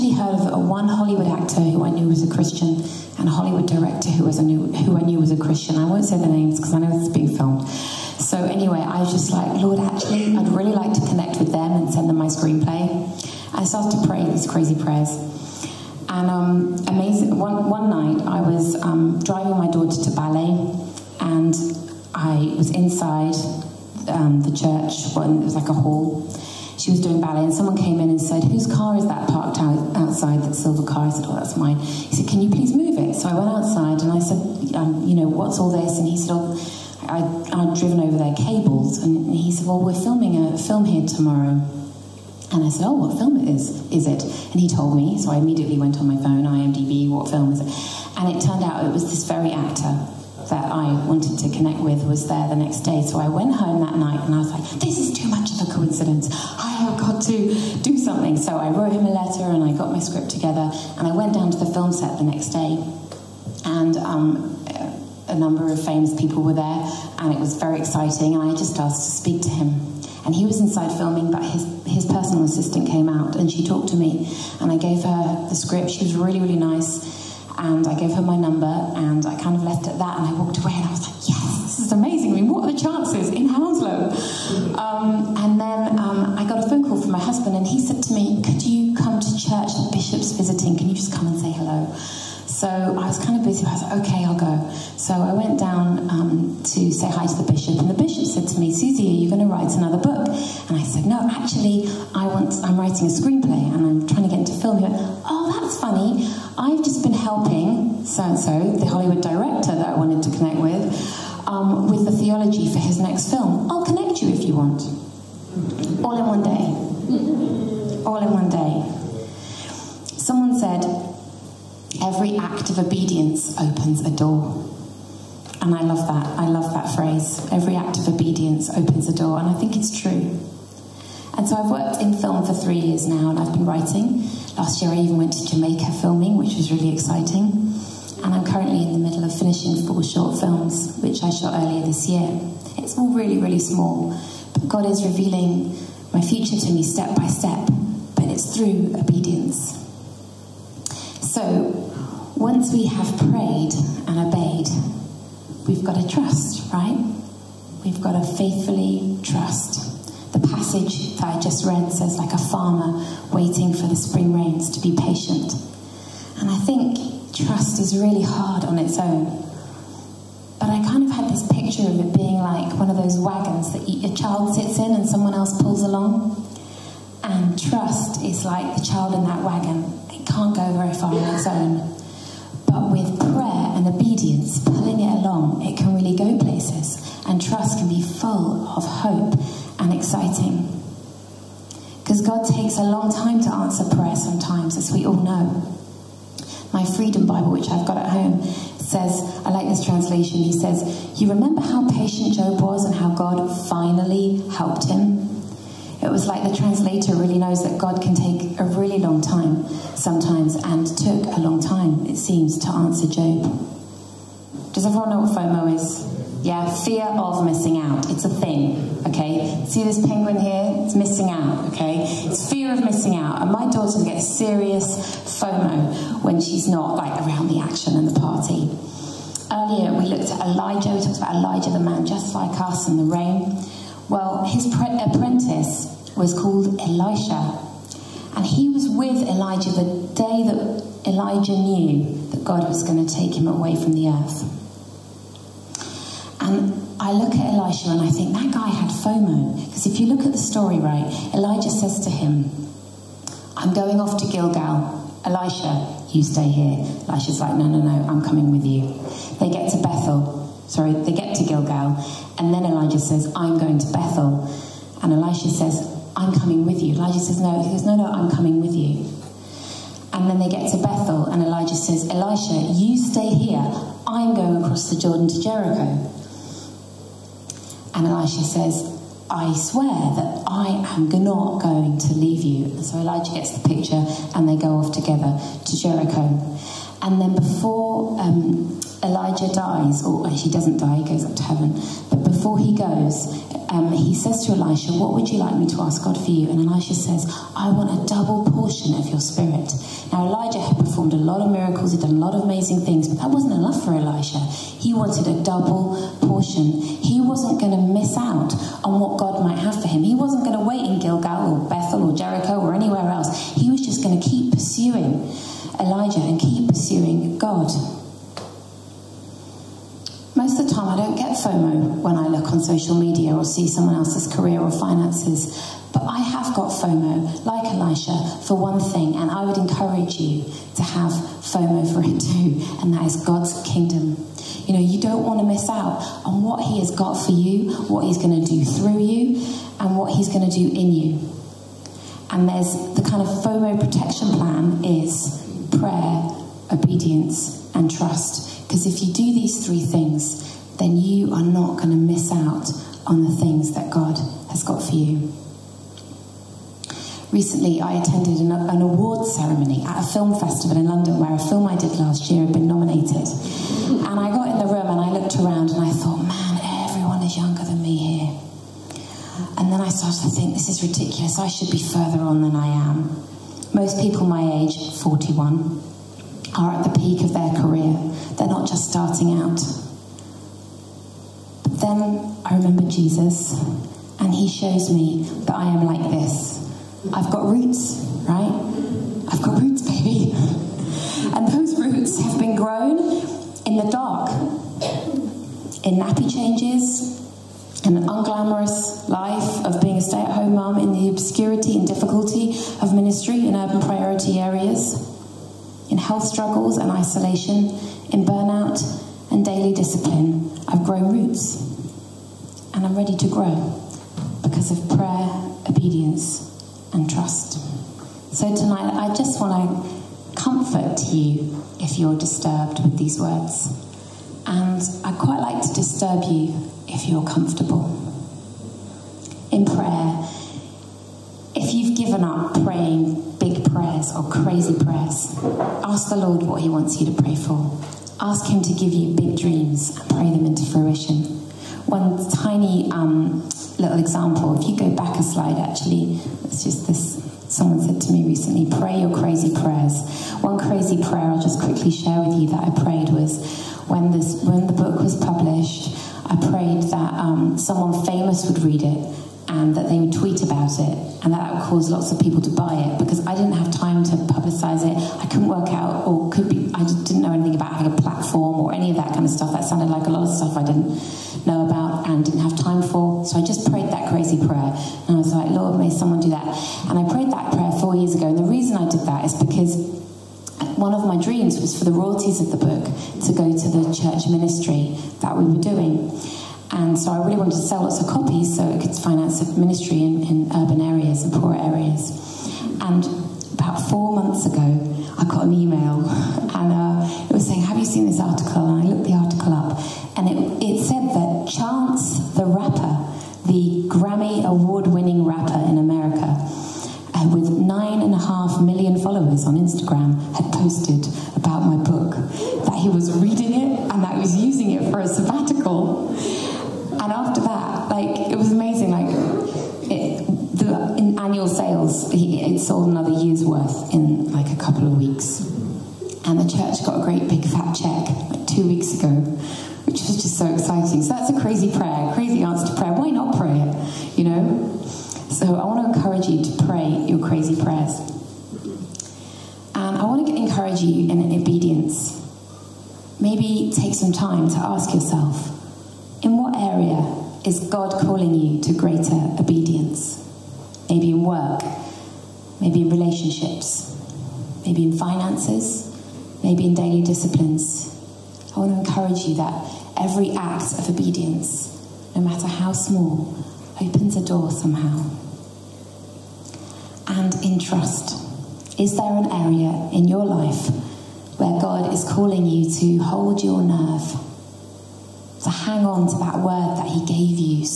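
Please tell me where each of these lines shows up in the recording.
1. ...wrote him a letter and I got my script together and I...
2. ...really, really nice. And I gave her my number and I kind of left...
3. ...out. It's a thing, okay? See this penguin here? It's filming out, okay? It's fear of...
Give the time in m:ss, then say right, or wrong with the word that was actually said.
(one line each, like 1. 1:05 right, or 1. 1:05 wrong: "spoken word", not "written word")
1. 0:58 right
2. 1:16 right
3. 3:37 wrong: "missing", not "filming".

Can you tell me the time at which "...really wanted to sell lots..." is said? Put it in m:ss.
8:07.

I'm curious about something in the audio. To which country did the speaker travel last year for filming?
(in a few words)
Jamaica.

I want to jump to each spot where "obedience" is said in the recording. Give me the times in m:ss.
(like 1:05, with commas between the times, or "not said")
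2:02, 2:08, 2:28, 3:03, 5:46, 6:55, 9:20.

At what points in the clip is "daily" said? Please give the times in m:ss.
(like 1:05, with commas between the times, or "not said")
6:49, 9:16.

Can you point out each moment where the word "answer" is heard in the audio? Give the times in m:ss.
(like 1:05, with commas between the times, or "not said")
3:13, 3:32.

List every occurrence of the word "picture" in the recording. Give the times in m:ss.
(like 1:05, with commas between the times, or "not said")
2:51, 4:43.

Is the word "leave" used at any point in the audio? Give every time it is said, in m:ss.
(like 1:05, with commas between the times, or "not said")
4:42.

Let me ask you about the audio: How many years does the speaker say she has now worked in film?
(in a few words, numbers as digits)
3.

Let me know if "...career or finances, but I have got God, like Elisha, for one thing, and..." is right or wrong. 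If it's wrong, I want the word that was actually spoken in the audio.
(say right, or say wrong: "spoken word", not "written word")
wrong: "FOMO", not "God".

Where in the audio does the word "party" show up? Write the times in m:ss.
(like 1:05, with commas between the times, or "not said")
3:48.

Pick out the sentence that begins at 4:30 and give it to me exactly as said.
And then they get to Bethel, and Elijah says, Elisha, you stay here.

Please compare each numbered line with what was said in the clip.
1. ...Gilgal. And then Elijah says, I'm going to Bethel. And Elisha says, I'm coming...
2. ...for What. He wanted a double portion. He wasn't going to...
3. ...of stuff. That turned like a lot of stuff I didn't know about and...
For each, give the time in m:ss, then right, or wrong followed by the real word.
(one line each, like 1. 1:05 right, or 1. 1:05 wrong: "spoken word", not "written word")
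1. 4:21 right
2. 5:03 wrong: "Elisha", not "What"
3. 7:49 wrong: "sounded", not "turned".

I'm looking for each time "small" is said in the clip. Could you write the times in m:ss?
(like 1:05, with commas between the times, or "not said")
2:23, 9:22.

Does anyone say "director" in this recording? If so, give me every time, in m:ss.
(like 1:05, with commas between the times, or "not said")
0:03, 1:49.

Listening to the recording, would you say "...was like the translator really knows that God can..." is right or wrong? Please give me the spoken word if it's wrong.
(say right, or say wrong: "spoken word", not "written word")
right.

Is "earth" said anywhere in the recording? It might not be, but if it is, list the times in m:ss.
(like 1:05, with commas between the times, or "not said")
4:04.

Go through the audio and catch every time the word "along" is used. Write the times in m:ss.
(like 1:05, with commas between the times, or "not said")
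2:55, 3:05.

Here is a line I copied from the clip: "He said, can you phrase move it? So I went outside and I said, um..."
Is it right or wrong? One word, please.
wrong.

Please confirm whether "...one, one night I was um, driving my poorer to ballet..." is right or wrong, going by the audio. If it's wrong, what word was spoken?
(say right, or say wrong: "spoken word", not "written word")
wrong: "daughter", not "poorer".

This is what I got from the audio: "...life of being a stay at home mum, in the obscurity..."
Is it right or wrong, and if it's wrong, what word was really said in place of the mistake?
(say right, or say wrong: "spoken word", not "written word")
right.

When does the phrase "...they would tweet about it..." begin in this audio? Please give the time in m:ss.
7:39.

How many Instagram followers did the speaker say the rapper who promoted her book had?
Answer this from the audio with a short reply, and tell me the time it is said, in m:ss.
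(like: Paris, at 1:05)
9.5 million, at 8:27.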